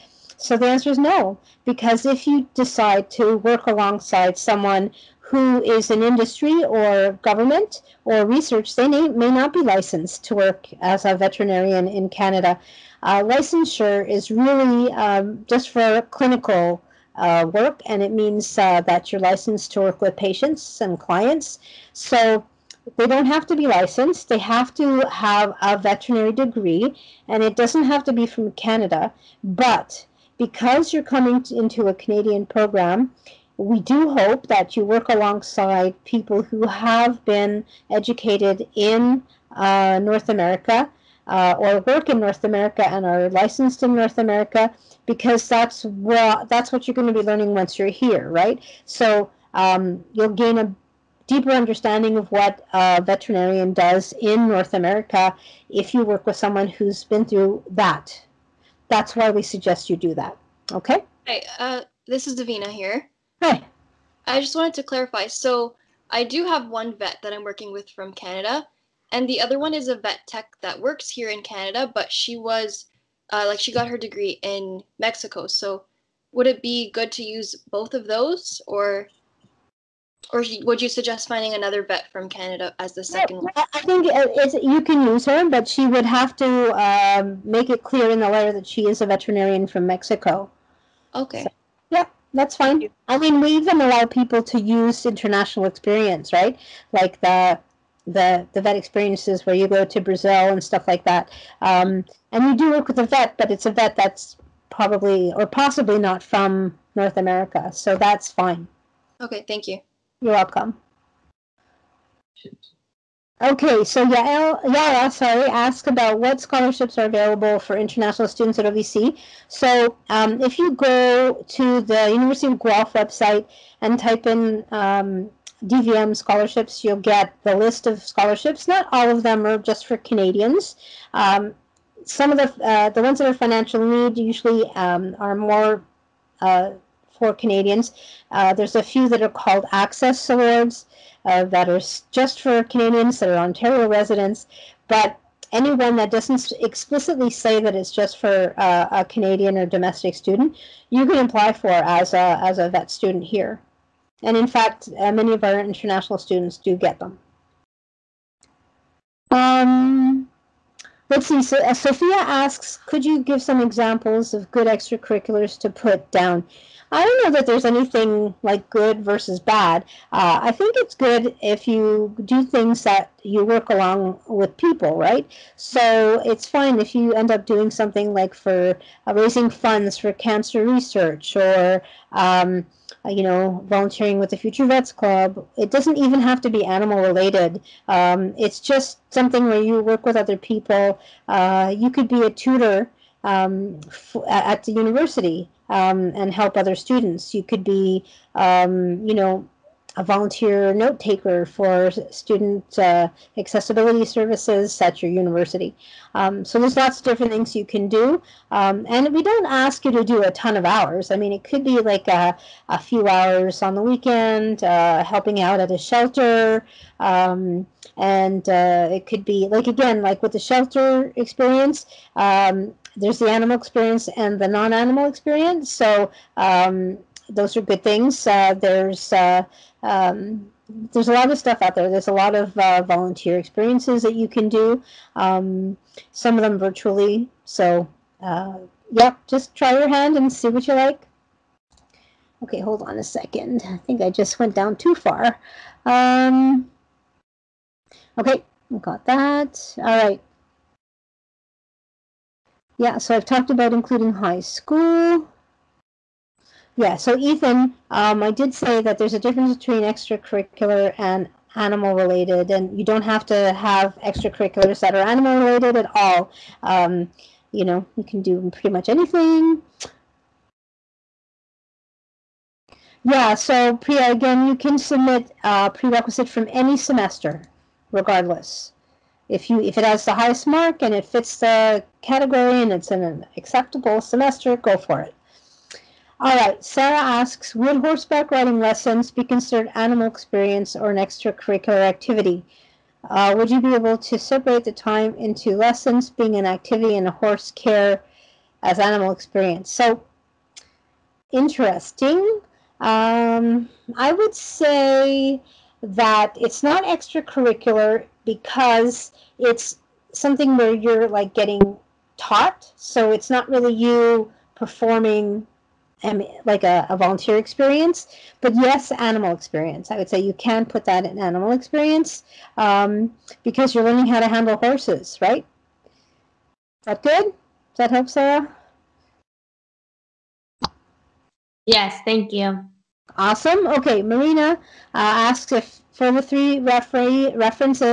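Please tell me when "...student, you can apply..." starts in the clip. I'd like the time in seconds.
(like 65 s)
150 s.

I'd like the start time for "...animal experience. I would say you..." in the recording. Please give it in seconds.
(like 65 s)
318 s.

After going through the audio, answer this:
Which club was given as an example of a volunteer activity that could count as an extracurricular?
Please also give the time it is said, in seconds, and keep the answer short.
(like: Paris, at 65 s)
Future Vets Club, at 184 s.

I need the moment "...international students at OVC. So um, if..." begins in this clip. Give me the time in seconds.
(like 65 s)
117 s.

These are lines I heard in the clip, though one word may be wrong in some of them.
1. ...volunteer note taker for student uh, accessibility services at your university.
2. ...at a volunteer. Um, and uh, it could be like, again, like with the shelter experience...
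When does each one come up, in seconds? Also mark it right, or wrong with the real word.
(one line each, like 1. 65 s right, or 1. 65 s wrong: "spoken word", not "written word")
1. 200 s right
2. 215 s wrong: "shelter", not "volunteer".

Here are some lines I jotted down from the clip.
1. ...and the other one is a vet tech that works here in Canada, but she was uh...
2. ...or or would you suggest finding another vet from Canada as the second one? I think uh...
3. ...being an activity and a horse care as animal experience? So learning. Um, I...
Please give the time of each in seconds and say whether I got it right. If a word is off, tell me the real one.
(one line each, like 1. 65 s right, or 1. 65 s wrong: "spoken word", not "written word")
1. 69 s right
2. 78 s right
3. 296 s wrong: "interesting", not "learning".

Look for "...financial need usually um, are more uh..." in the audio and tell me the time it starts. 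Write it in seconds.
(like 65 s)
133 s.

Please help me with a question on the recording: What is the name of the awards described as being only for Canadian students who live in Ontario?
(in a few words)
Access Awards.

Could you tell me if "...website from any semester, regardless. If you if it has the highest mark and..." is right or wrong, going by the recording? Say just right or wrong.
wrong.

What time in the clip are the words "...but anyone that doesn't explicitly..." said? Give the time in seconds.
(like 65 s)
144 s.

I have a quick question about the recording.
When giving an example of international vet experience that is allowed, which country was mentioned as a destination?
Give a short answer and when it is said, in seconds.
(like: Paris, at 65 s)
Brazil, at 99 s.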